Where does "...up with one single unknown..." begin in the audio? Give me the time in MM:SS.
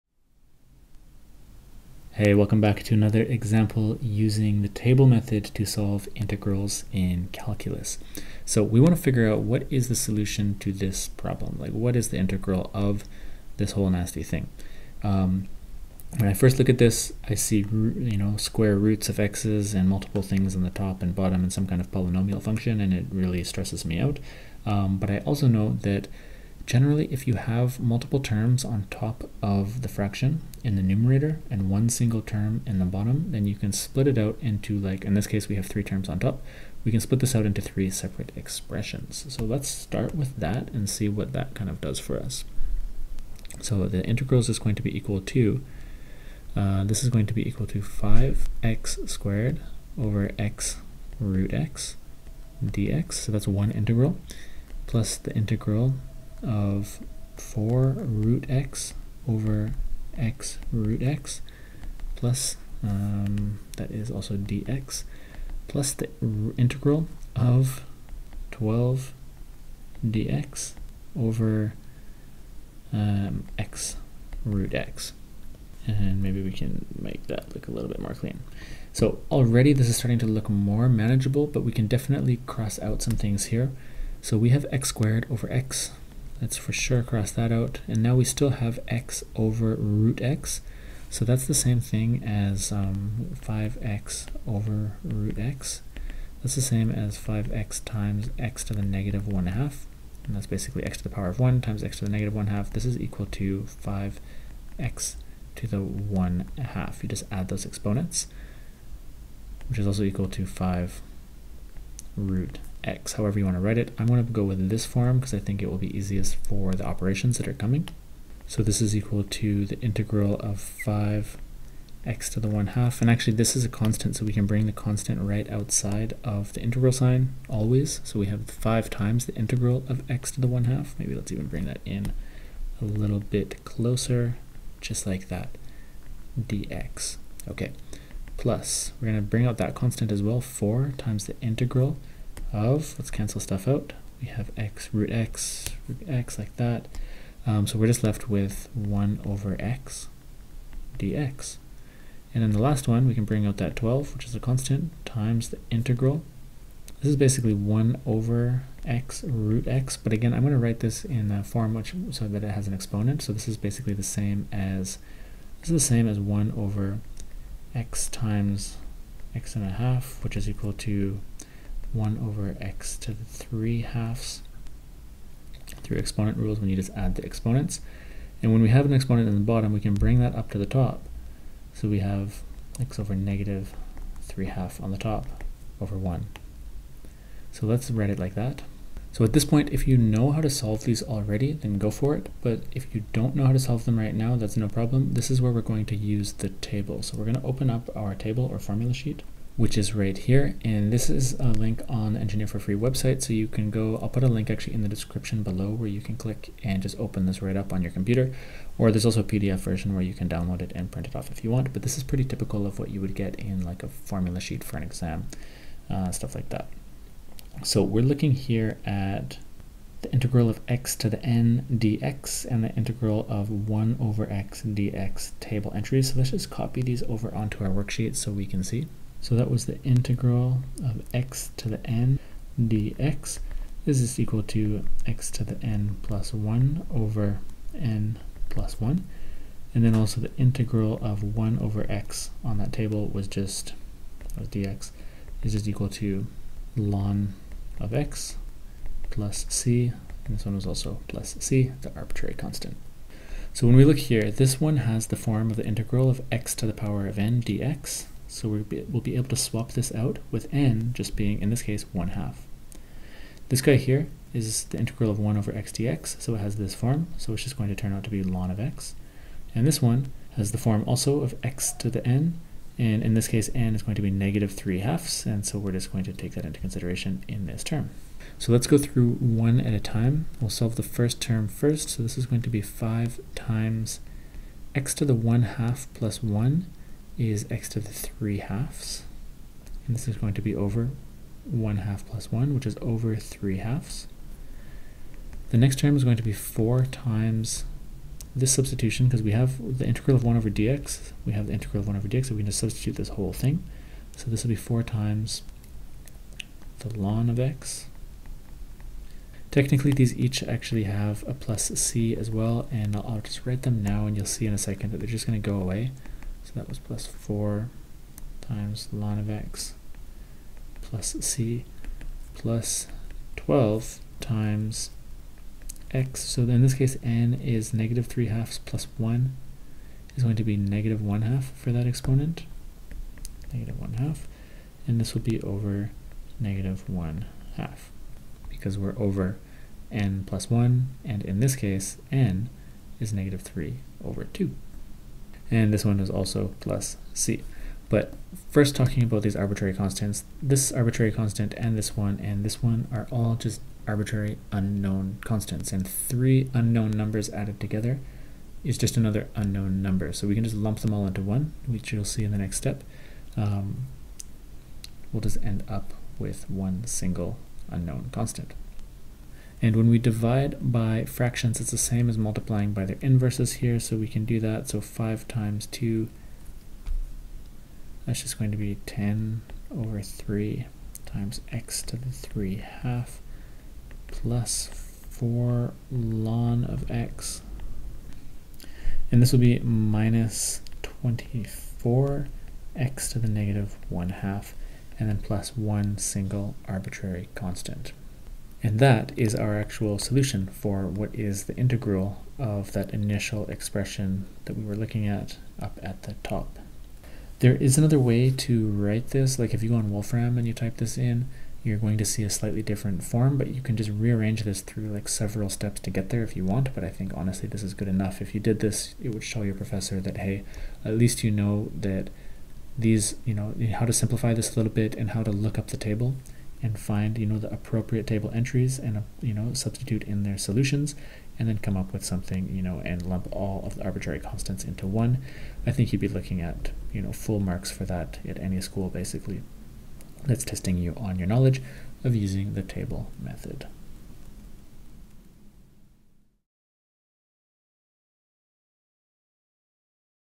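06:05.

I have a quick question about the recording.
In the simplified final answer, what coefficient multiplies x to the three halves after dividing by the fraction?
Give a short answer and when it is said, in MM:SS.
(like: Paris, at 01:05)
10/3, at 06:18.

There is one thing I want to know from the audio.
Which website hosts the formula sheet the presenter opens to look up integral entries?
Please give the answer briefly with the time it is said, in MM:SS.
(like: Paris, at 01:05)
Engineer for Free, at 03:22.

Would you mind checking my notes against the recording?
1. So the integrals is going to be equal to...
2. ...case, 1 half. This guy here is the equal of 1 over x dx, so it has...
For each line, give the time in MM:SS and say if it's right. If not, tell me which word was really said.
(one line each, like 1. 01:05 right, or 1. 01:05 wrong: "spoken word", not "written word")
1. 00:43 right
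2. 04:21 wrong: "integral", not "equal".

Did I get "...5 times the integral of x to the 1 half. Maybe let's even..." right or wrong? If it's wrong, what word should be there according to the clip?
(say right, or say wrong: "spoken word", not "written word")
right.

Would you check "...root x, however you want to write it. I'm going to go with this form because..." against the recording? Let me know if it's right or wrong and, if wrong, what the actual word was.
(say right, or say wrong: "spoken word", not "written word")
right.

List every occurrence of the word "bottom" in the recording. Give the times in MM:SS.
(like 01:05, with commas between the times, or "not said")
00:21, 00:32, 02:59.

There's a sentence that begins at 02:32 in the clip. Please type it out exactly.
And then the last one, we can bring out that 12, which is a constant, times the integral.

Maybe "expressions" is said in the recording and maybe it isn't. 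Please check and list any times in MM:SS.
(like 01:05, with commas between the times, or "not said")
00:38, 06:43.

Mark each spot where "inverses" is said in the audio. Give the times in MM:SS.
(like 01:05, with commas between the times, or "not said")
06:12.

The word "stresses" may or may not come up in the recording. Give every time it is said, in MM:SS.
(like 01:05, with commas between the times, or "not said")
00:23.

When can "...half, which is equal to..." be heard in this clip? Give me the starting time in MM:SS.
02:49.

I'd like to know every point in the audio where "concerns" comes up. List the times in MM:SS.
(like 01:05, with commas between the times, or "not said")
not said.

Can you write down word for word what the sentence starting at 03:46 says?
So let's just copy these over onto our worksheet so we can see.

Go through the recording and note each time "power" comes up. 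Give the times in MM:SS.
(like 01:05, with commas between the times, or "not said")
01:41, 04:16.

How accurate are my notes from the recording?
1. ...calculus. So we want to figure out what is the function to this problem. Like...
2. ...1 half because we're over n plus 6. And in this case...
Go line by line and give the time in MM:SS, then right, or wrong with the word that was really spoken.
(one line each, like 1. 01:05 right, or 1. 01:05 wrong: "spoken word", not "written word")
1. 00:07 wrong: "solution", not "function"
2. 05:36 wrong: "1", not "6".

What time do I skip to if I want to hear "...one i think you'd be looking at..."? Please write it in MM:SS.
07:14.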